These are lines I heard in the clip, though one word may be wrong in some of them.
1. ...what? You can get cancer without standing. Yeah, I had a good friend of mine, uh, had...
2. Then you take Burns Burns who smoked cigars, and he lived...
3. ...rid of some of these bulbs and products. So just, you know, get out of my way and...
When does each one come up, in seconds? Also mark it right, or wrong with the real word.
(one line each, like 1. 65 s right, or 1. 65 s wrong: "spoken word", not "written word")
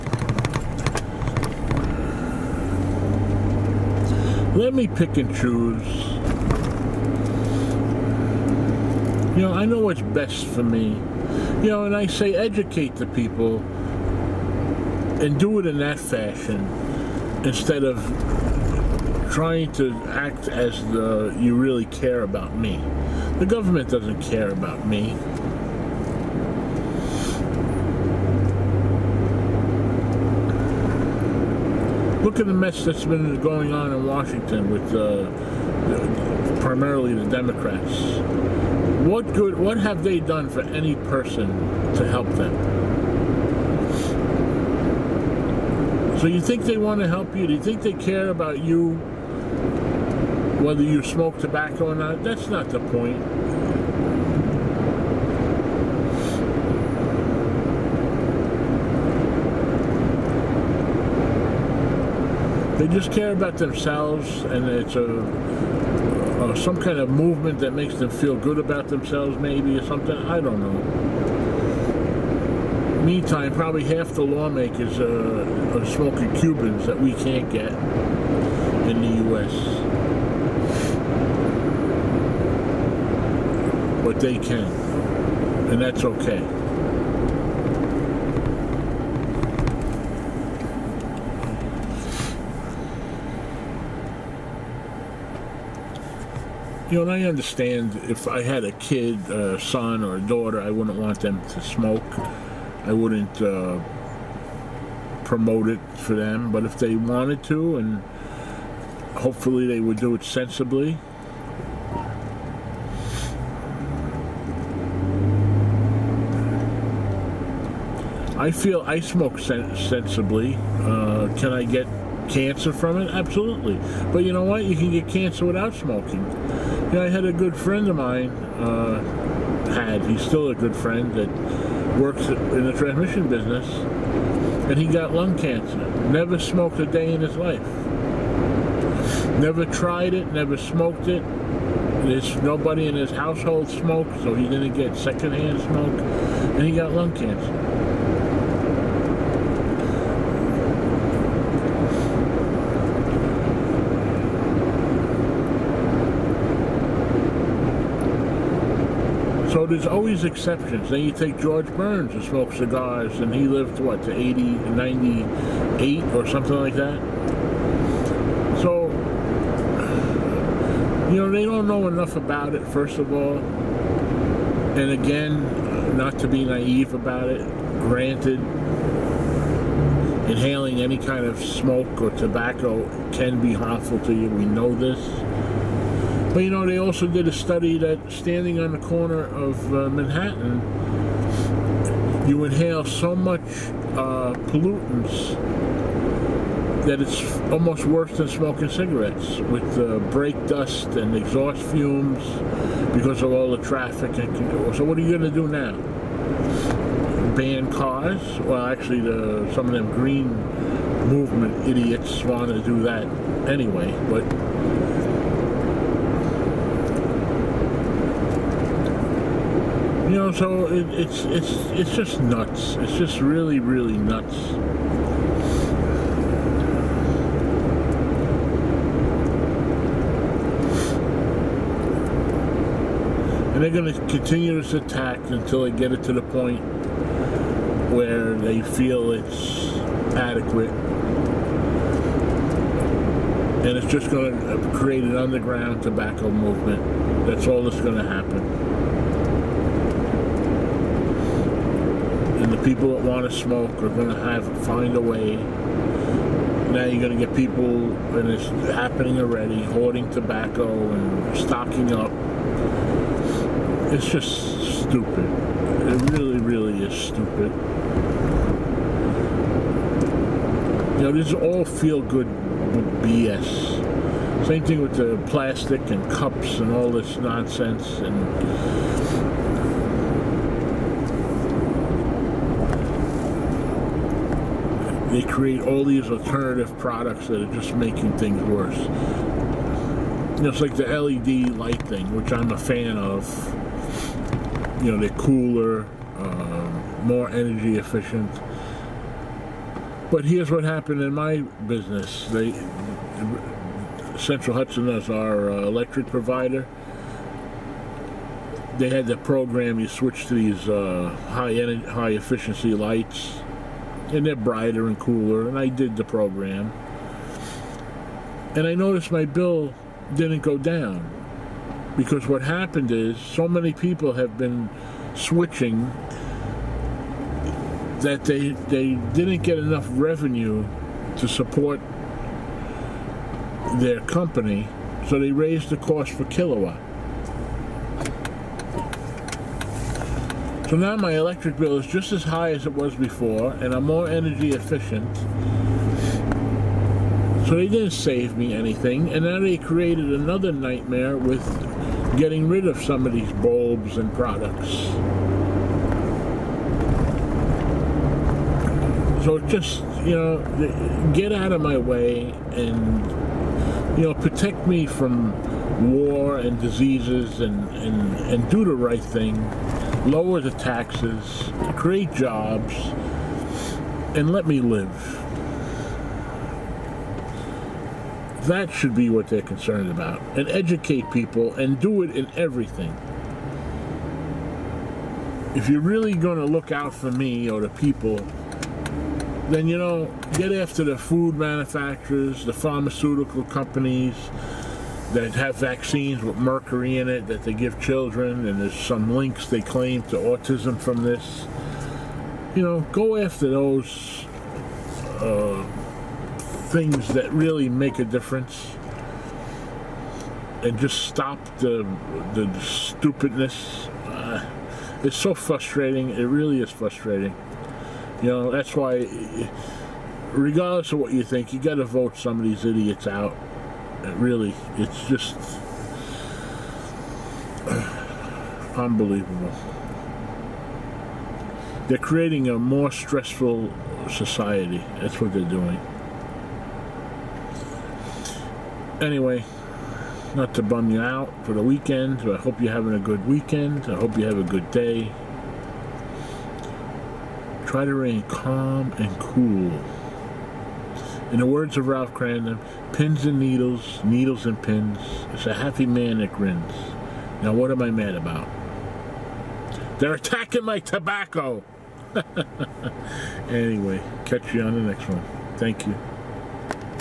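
1. 124 s wrong: "smoking", not "standing"
2. 160 s wrong: "George", not "Burns"
3. 352 s right.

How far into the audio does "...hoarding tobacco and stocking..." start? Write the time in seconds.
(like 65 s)
259 s.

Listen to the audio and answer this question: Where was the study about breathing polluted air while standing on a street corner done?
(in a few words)
Manhattan.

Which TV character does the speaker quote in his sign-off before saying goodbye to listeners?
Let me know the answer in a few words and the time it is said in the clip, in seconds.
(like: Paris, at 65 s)
Ralph Kramden, at 451 s.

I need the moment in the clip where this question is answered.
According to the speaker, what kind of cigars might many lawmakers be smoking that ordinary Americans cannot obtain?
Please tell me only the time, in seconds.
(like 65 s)
76 s.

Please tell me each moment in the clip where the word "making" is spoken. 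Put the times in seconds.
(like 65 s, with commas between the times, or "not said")
287 s.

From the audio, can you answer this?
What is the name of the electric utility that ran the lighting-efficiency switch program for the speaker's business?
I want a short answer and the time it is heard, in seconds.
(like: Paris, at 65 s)
Central Hudson, at 304 s.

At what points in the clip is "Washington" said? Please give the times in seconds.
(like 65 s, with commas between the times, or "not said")
34 s.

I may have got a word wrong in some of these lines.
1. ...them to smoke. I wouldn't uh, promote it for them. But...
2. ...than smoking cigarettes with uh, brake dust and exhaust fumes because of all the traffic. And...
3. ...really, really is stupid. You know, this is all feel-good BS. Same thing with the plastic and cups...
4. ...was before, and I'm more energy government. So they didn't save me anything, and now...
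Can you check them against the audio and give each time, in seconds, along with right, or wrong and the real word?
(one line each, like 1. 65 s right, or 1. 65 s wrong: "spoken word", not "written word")
1. 101 s right
2. 198 s right
3. 266 s right
4. 342 s wrong: "efficient", not "government".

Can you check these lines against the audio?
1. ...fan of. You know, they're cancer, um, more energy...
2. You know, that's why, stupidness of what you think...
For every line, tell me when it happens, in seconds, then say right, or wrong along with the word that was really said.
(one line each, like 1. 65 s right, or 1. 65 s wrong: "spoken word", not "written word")
1. 292 s wrong: "cooler", not "cancer"
2. 418 s wrong: "regardless", not "stupidness".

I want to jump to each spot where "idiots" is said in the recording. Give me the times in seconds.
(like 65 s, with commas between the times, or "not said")
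211 s, 422 s.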